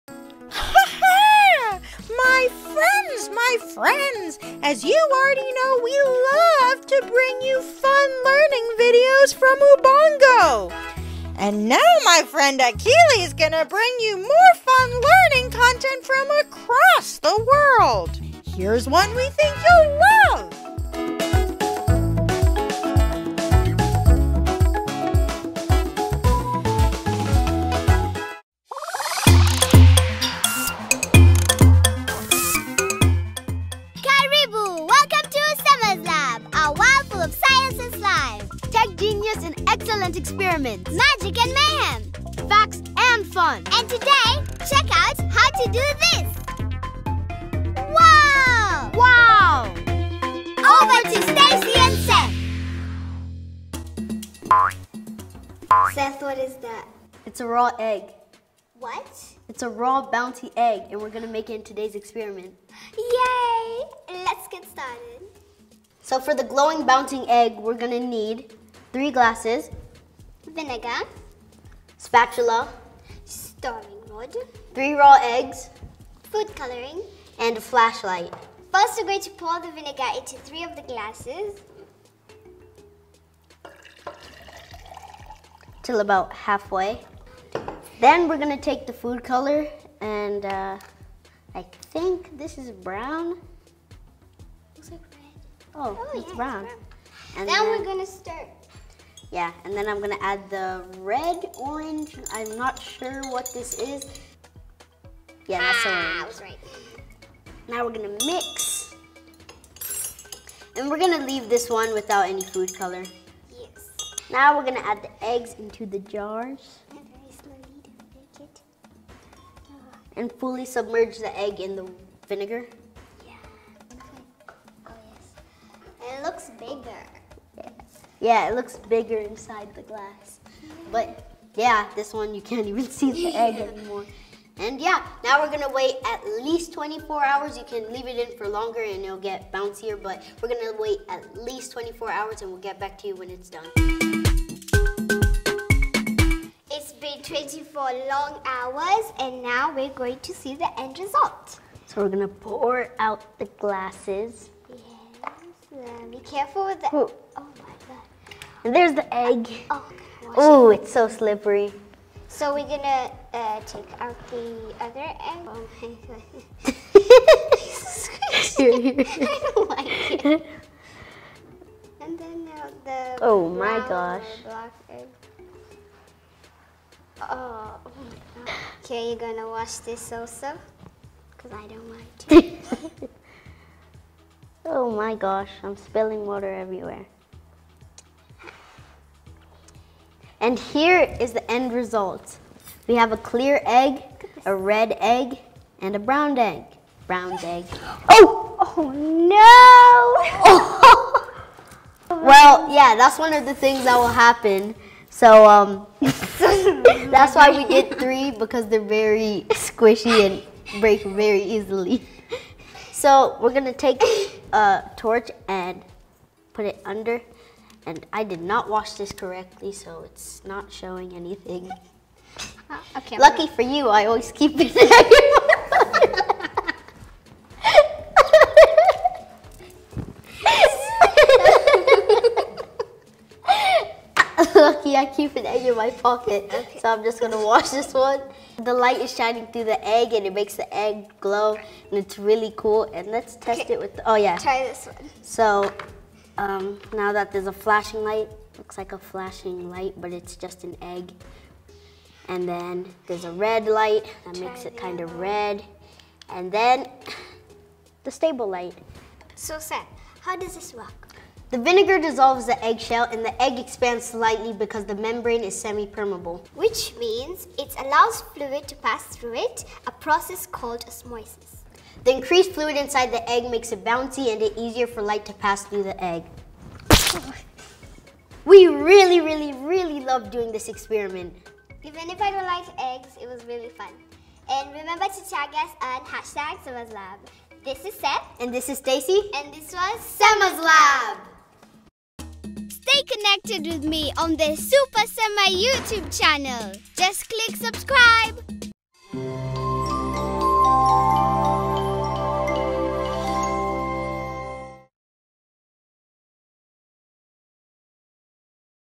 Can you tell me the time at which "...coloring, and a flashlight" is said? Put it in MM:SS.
01:16.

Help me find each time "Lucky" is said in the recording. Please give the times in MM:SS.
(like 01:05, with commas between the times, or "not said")
03:43, 03:54.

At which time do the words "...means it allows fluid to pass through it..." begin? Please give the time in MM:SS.
04:26.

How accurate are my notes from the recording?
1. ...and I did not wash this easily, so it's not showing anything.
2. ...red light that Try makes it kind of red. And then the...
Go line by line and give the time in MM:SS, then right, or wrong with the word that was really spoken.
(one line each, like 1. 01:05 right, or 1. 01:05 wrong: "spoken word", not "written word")
1. 03:37 wrong: "correctly", not "easily"
2. 04:13 right.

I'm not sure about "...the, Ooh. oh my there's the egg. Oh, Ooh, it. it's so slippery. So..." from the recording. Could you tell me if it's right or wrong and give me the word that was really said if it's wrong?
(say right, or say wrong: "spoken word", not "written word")
right.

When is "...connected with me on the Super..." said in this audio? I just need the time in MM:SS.
04:53.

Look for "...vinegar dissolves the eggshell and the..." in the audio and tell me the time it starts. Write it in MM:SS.
04:21.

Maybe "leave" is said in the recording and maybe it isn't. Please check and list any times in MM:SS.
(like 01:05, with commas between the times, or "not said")
01:51, 02:17.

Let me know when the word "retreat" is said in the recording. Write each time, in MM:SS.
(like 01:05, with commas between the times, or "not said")
not said.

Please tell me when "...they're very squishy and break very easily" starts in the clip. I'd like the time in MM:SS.
03:28.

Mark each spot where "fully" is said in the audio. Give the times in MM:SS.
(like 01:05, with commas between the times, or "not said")
02:00.